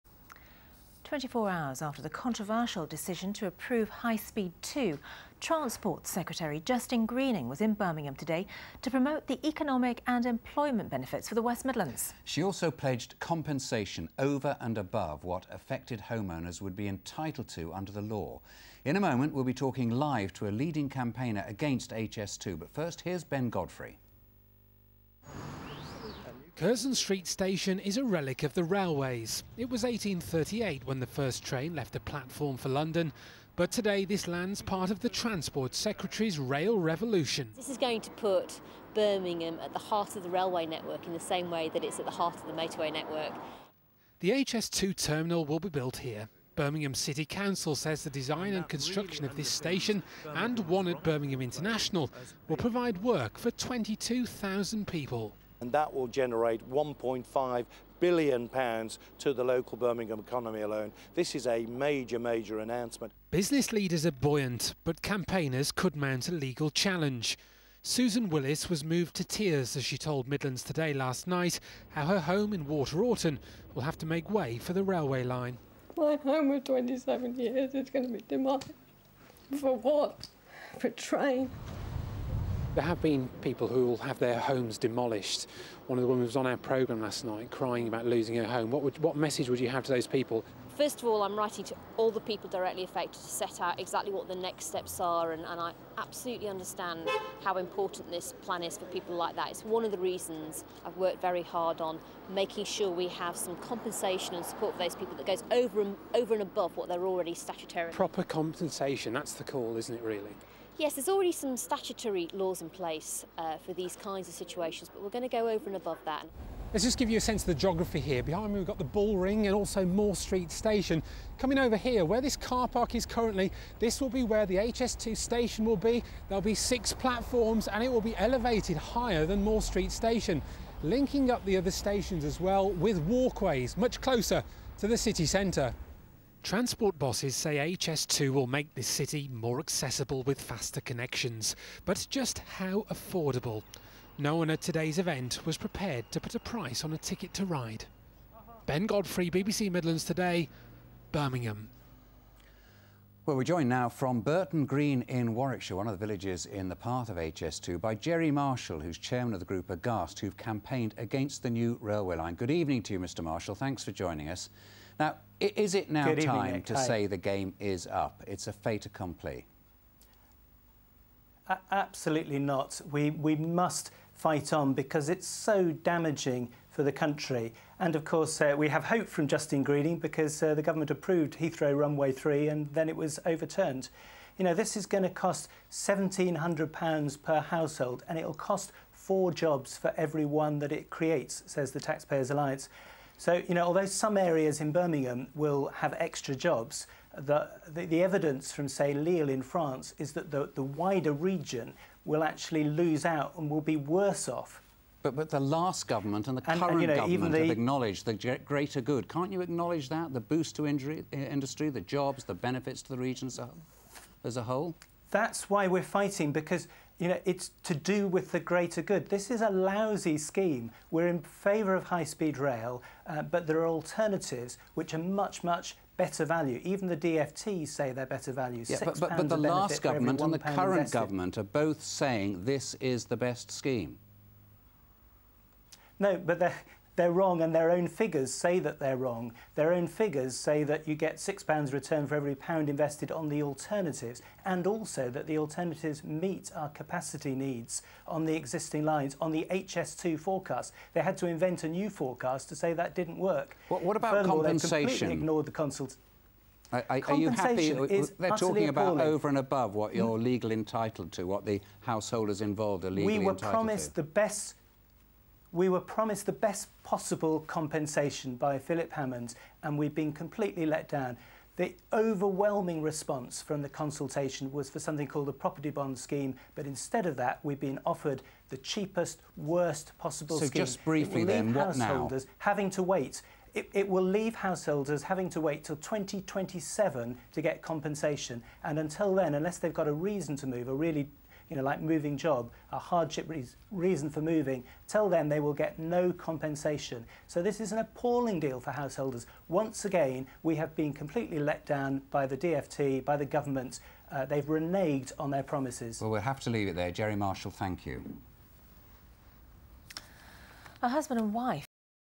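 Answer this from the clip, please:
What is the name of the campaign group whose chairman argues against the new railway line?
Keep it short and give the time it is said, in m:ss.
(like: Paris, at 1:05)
Aghast, at 2:39.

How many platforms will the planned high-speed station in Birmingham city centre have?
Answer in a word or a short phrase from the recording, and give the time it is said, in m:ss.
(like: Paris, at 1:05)
6, at 2:06.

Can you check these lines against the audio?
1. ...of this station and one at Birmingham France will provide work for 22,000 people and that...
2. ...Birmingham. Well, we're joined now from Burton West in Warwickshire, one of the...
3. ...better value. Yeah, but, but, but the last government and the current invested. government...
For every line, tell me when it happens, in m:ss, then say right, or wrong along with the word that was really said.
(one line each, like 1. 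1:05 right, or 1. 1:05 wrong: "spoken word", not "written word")
1. 0:49 wrong: "International", not "France"
2. 2:31 wrong: "Green", not "West"
3. 3:48 right.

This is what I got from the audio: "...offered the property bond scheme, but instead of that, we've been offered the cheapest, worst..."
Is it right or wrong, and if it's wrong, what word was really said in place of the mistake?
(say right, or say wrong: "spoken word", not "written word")
wrong: "called", not "offered".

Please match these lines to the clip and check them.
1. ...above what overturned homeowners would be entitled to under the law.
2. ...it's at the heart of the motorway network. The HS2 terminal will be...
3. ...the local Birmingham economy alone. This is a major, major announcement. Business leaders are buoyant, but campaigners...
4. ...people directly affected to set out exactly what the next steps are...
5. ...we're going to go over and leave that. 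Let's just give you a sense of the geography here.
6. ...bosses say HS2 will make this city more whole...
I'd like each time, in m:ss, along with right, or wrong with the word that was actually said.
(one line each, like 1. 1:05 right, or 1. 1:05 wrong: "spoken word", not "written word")
1. 0:14 wrong: "affected", not "overturned"
2. 0:41 right
3. 0:59 right
4. 1:32 right
5. 1:55 wrong: "above", not "leave"
6. 2:16 wrong: "accessible", not "whole".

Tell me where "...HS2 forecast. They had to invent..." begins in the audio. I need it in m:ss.
4:09.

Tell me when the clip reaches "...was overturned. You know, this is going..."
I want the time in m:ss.
3:02.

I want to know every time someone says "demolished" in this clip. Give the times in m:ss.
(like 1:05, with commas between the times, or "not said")
1:18, 1:24.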